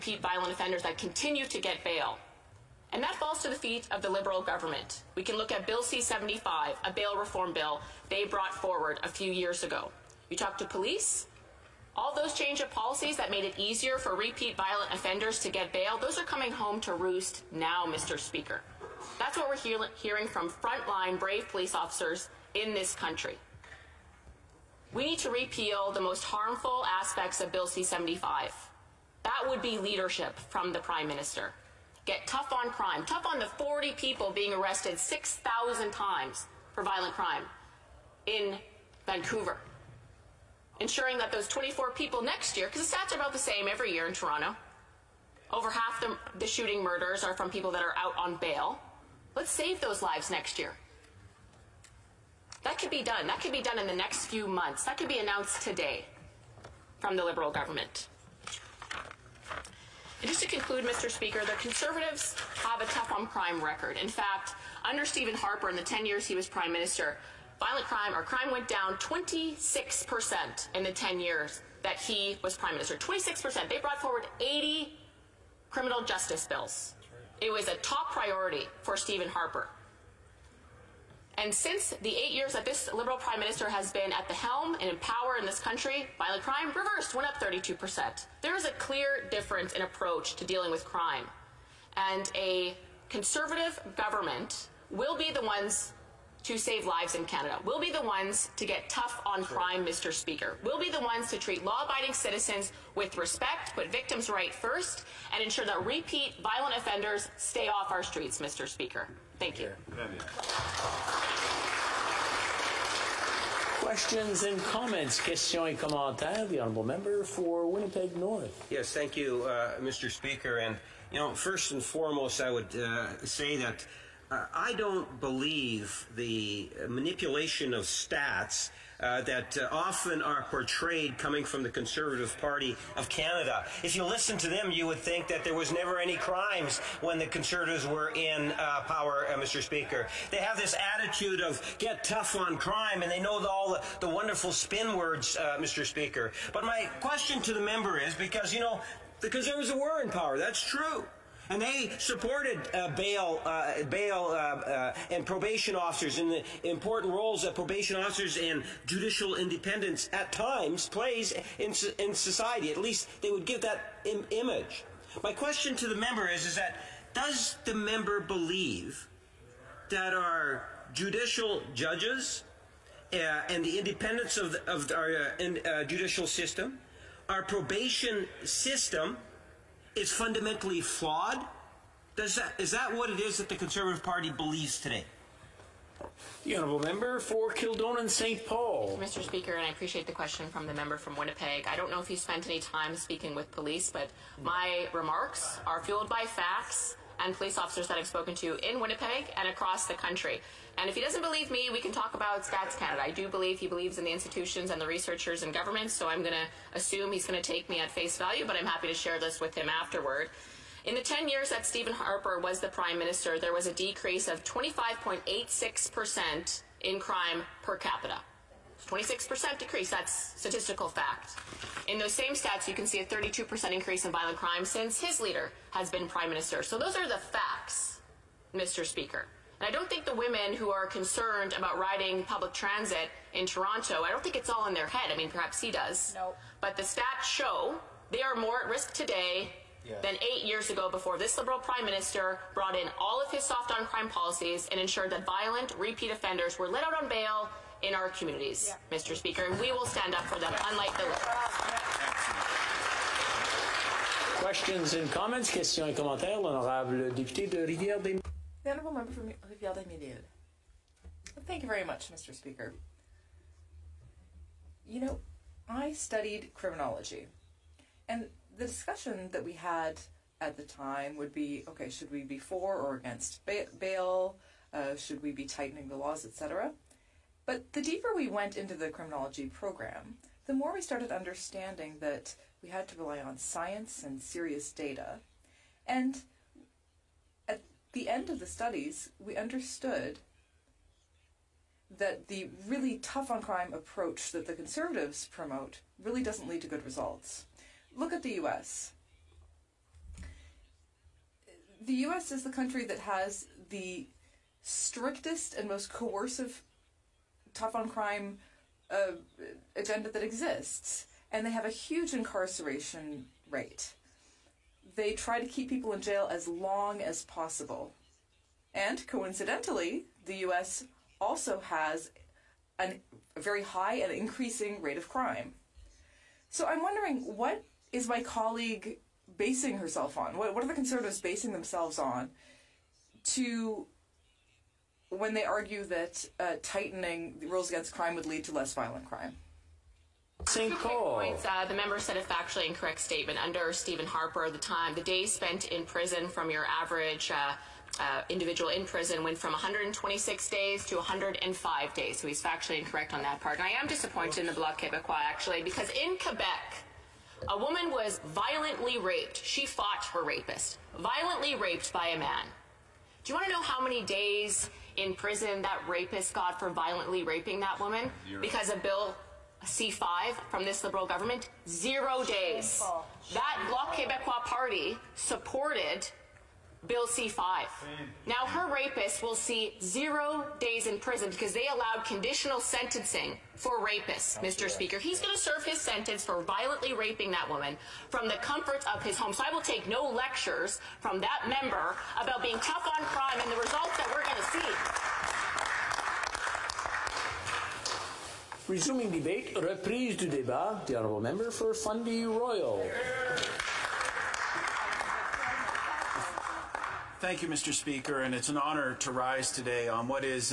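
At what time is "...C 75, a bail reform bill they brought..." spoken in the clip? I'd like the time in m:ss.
0:05.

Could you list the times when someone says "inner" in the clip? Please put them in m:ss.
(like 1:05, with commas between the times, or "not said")
not said.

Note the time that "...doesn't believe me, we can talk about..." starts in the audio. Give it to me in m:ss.
3:20.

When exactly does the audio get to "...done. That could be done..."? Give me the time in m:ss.
0:53.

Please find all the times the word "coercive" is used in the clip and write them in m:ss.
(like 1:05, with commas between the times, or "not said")
5:05.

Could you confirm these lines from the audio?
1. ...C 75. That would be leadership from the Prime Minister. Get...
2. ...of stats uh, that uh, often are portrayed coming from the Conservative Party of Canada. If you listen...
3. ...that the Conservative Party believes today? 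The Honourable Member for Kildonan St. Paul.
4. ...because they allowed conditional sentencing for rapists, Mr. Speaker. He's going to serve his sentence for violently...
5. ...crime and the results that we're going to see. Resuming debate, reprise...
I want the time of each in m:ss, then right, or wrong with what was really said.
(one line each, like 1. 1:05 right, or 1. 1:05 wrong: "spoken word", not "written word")
1. 0:27 right
2. 2:07 right
3. 3:03 right
4. 6:21 right
5. 6:33 right.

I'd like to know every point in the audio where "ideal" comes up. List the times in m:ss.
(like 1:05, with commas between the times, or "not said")
not said.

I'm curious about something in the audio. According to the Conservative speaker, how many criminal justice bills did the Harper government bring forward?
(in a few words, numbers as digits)
80.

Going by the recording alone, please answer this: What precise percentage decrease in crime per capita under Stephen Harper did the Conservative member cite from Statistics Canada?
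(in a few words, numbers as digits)
25.86%.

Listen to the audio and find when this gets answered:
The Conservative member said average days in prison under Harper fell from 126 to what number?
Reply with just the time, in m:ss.
5:50.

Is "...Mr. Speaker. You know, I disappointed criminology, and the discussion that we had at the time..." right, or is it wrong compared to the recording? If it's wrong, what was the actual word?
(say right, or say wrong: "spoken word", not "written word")
wrong: "studied", not "disappointed".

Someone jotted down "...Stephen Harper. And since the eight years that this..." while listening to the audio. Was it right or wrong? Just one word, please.
right.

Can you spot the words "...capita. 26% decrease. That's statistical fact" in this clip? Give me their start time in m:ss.
3:37.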